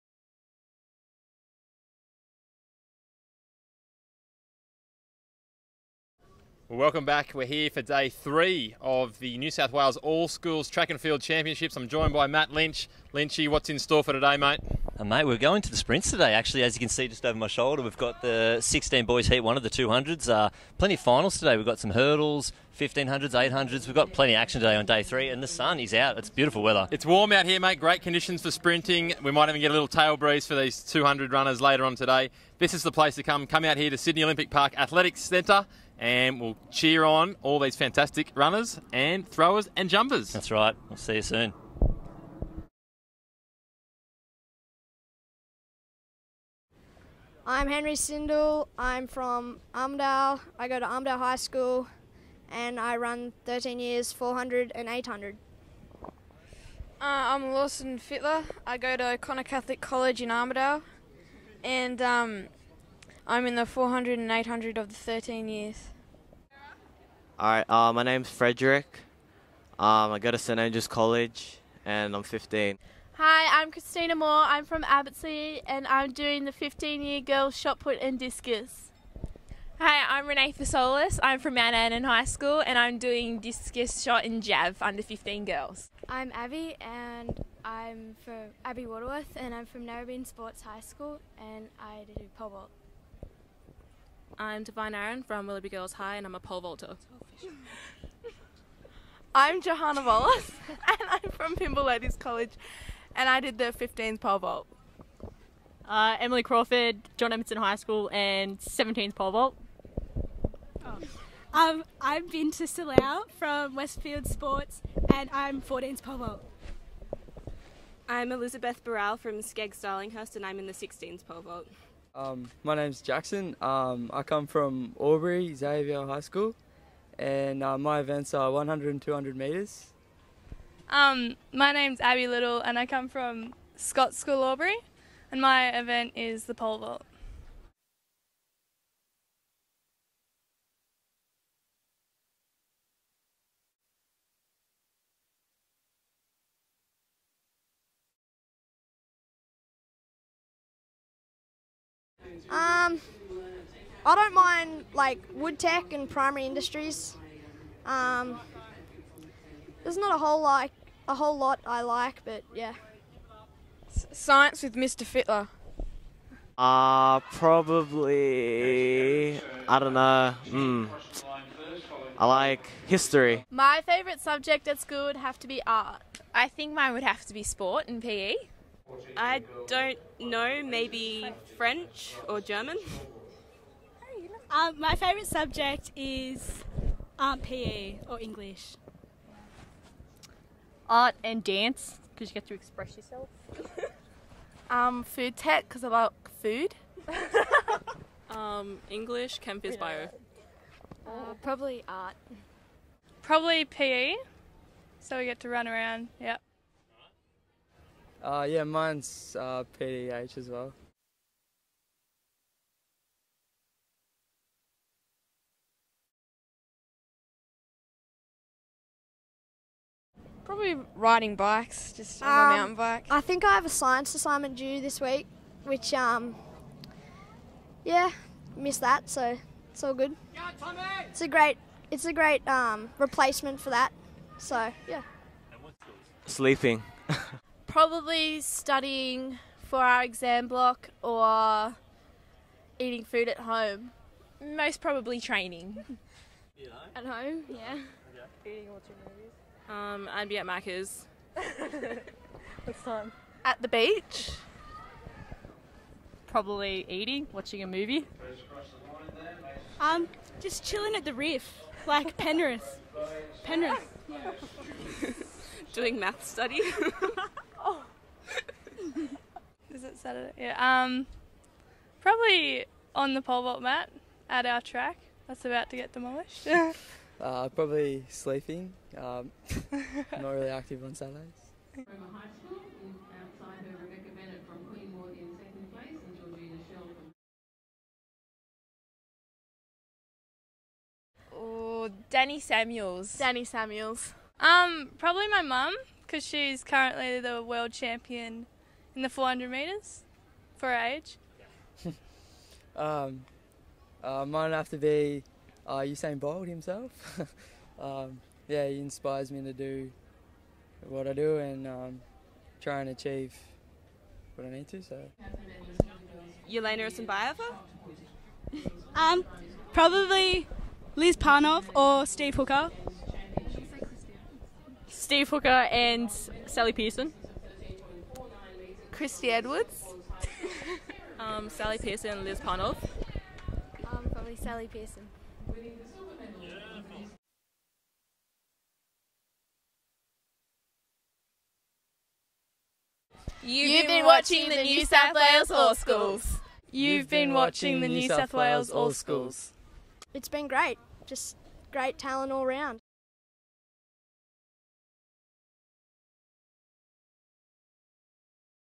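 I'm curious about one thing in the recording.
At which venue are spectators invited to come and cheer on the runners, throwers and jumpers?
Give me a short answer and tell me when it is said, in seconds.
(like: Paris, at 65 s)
Sydney Olympic Park Athletics Centre, at 33 s.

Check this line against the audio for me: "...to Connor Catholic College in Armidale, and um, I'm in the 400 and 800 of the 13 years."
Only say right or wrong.
right.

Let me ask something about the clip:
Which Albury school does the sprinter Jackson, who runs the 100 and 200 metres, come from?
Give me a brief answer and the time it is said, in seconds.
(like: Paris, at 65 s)
Albury Xavier High School, at 124 s.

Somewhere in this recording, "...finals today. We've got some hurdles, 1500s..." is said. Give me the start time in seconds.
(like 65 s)
20 s.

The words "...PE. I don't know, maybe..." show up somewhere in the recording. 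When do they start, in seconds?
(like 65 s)
178 s.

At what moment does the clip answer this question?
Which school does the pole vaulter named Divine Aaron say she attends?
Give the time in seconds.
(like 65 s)
95 s.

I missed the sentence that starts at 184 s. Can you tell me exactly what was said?
Um, my favourite subject is um, PE or English art and dance because you get to express yourself.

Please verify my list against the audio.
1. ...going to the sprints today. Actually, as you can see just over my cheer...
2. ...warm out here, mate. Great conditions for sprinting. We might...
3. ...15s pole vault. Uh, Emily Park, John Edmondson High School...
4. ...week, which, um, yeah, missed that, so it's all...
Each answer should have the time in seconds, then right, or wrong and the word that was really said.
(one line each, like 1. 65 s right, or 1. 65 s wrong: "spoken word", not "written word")
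1. 15 s wrong: "shoulder", not "cheer"
2. 27 s right
3. 103 s wrong: "Crawford", not "Park"
4. 224 s right.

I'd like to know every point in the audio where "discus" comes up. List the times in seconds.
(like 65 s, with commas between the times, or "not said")
78 s, 83 s.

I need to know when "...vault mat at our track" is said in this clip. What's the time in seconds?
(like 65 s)
273 s.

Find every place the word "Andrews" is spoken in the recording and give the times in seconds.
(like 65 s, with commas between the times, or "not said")
70 s.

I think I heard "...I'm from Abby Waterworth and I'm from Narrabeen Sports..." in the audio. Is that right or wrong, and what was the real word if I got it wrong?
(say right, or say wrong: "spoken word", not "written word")
right.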